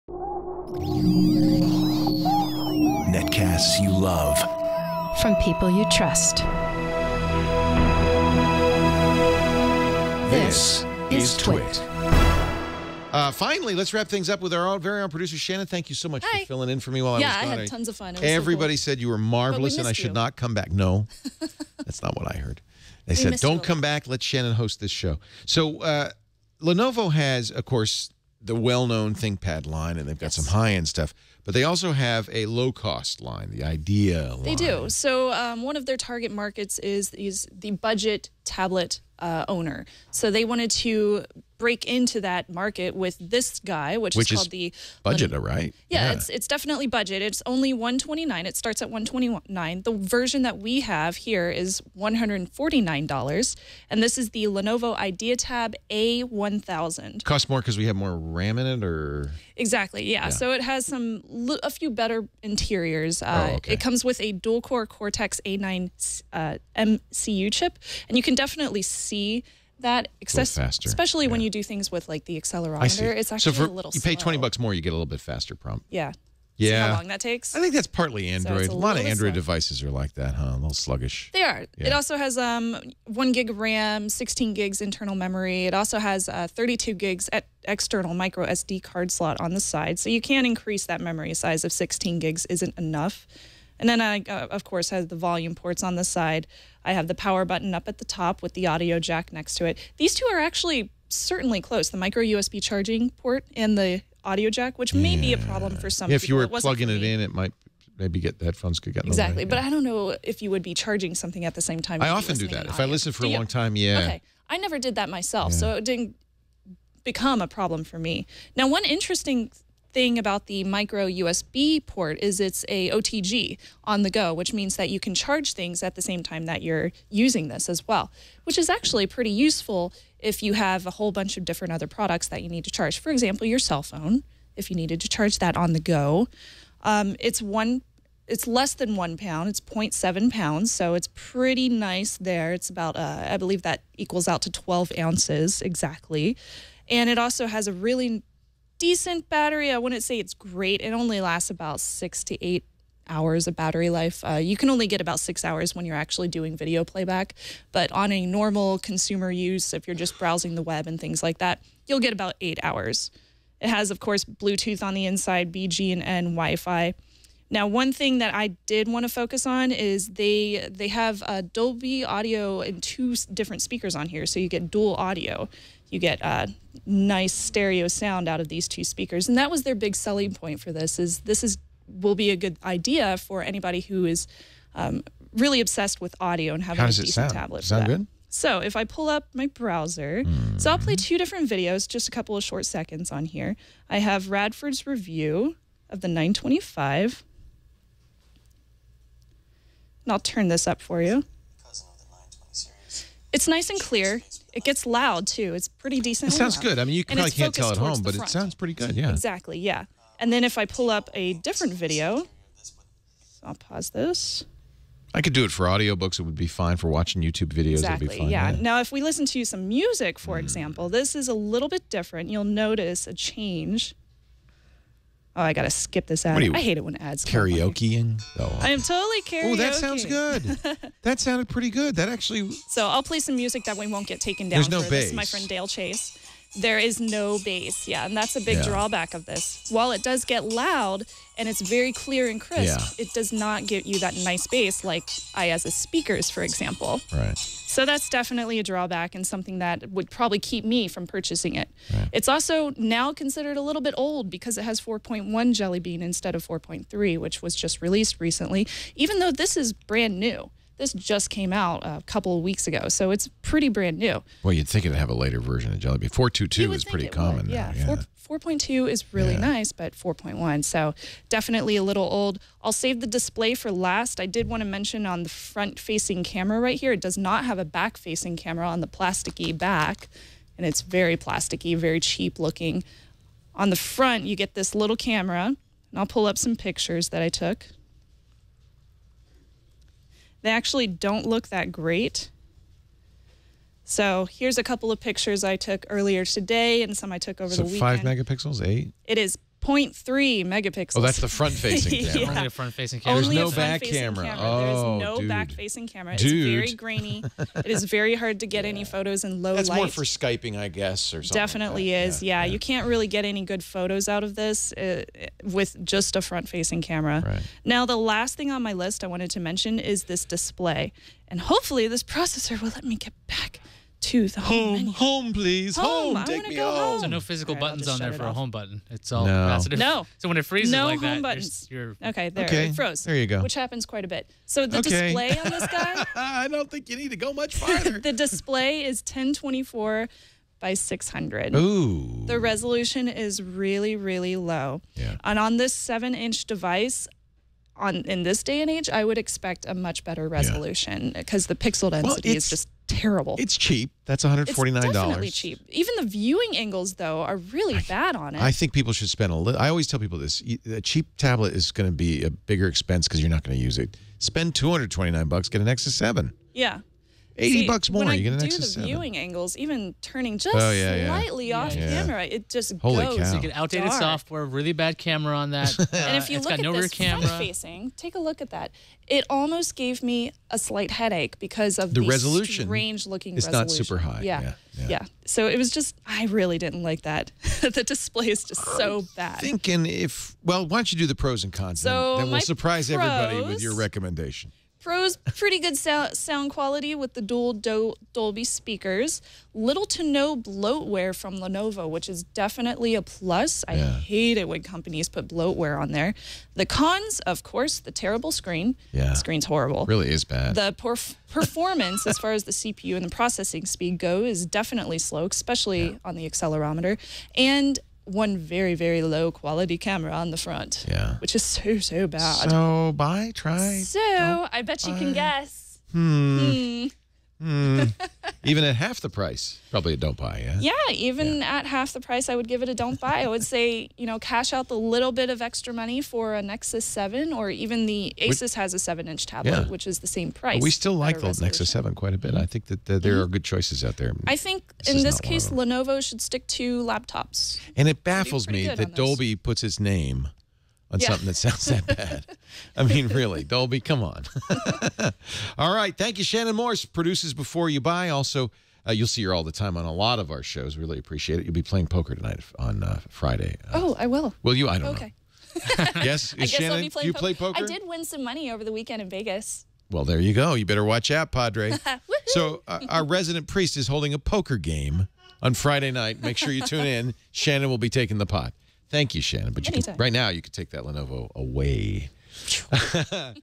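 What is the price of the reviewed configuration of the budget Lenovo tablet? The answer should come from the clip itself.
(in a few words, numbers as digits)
$149.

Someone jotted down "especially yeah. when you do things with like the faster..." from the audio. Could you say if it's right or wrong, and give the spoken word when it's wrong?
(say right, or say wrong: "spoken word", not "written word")
wrong: "accelerometer", not "faster".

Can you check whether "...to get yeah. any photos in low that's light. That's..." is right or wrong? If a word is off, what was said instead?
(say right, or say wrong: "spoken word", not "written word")
right.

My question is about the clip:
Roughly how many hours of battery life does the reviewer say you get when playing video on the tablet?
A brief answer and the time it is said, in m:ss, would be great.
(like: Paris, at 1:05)
6 hours, at 2:35.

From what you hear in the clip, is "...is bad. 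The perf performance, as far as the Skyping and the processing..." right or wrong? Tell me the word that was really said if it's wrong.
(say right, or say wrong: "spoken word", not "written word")
wrong: "CPU", not "Skyping".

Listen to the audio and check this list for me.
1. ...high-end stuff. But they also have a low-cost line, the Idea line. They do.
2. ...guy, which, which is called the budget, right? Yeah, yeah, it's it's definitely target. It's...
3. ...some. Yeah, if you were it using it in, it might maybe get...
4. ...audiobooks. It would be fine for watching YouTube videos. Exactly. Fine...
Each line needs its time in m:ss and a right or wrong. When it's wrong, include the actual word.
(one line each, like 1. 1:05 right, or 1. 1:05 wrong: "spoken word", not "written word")
1. 0:30 right
2. 0:43 wrong: "budget", not "target"
3. 1:45 wrong: "plugging", not "using"
4. 3:35 right.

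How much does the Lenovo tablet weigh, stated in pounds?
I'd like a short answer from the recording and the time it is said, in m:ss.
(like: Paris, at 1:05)
0.7 pounds, at 2:19.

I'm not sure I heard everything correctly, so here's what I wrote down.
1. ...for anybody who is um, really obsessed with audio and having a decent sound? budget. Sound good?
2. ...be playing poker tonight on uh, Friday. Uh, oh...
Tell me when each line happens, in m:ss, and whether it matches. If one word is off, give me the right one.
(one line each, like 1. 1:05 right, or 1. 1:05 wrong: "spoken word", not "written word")
1. 3:03 wrong: "tablet", not "budget"
2. 7:41 right.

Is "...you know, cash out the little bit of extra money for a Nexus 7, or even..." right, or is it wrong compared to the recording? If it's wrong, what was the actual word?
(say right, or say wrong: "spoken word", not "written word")
right.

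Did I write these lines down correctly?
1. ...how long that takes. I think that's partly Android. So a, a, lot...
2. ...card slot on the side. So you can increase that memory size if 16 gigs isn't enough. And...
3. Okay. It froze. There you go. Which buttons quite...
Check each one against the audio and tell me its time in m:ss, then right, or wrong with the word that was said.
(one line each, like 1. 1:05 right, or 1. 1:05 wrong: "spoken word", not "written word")
1. 1:16 right
2. 1:28 right
3. 5:32 wrong: "happens", not "buttons".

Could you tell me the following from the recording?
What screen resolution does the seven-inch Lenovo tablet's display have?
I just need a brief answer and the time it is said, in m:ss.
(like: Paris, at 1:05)
1024 by 600, at 5:39.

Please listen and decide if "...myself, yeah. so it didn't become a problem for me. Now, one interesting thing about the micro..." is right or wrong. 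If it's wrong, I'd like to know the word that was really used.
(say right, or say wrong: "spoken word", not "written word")
right.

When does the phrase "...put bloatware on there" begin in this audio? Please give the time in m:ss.
6:45.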